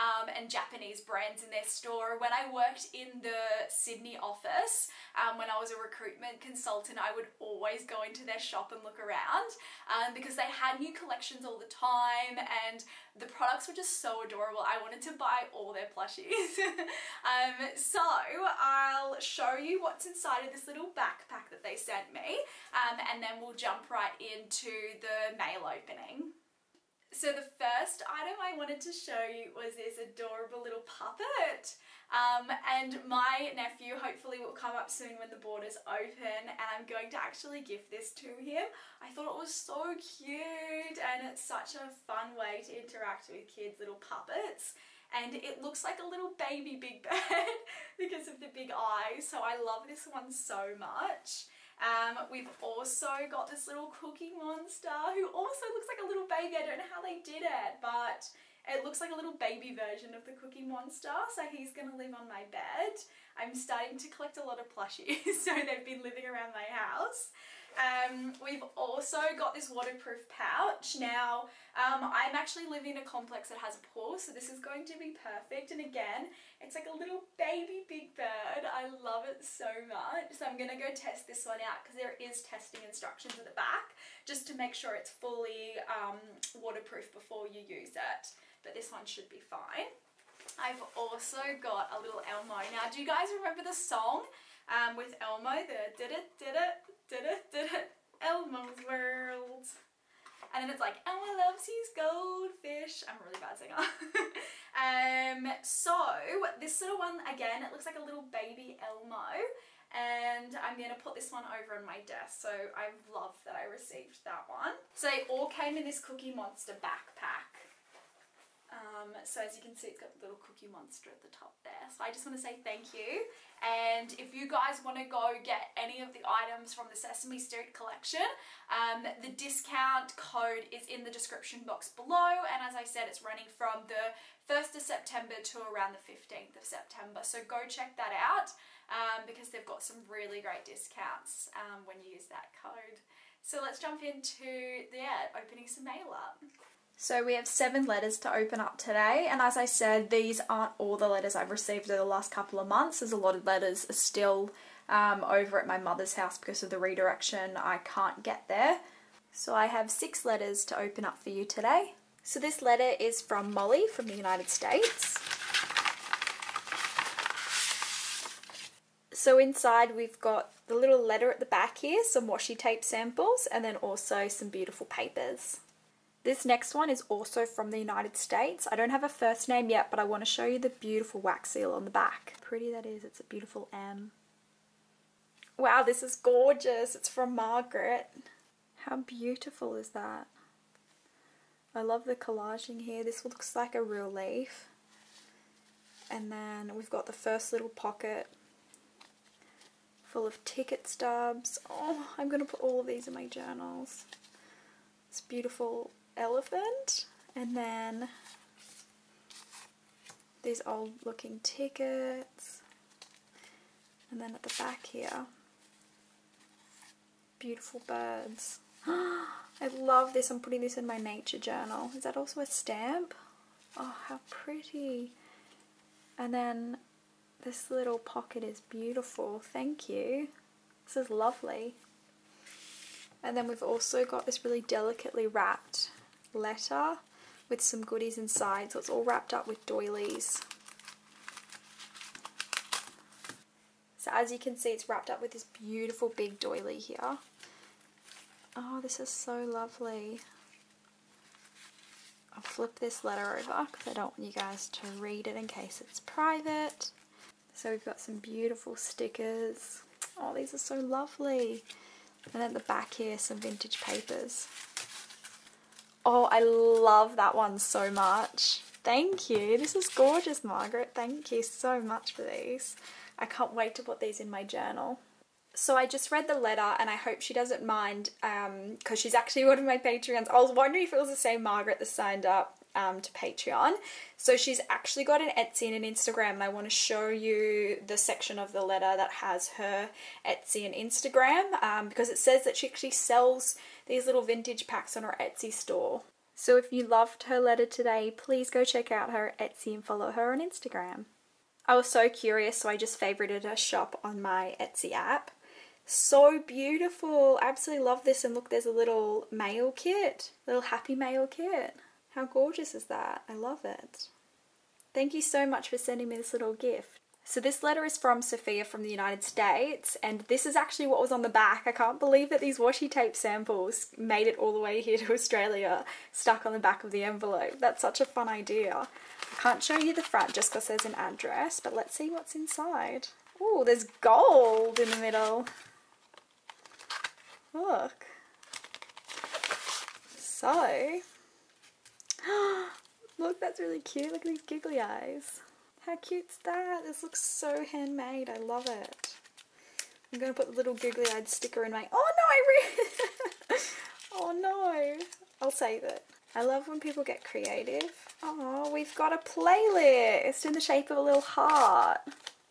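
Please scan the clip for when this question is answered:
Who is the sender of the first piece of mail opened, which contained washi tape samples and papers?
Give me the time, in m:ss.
2:43.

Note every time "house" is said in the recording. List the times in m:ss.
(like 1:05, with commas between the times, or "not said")
1:06, 2:36.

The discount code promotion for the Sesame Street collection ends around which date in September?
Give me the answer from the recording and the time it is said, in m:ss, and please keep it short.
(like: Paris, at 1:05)
15th of September, at 2:16.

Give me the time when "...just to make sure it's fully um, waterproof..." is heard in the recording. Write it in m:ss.
1:24.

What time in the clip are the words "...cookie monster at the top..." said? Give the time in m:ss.
2:00.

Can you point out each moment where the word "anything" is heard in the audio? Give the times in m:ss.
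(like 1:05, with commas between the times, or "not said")
not said.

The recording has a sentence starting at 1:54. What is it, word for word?
So they all came in this Cookie Monster backpack.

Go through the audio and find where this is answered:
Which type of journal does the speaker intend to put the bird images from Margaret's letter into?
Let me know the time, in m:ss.
3:40.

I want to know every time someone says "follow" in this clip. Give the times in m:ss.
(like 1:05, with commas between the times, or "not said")
4:59.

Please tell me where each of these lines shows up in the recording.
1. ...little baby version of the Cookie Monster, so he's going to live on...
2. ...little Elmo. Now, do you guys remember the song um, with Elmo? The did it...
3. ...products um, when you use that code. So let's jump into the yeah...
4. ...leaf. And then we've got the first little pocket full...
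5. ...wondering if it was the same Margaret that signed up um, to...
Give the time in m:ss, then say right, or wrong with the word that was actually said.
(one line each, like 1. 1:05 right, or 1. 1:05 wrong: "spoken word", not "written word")
1. 0:59 right
2. 1:32 right
3. 2:20 wrong: "discounts", not "products"
4. 3:14 right
5. 4:40 right.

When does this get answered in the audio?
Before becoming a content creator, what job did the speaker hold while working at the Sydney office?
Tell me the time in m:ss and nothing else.
0:05.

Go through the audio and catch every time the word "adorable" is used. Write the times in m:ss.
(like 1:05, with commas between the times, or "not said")
0:14, 0:29.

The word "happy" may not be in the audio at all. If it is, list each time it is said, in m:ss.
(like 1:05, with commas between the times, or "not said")
5:10.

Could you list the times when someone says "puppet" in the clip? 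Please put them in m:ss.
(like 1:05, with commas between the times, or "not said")
0:30, 0:44.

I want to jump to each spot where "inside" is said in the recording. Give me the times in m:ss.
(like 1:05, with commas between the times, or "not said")
0:20, 2:49, 3:58, 5:32.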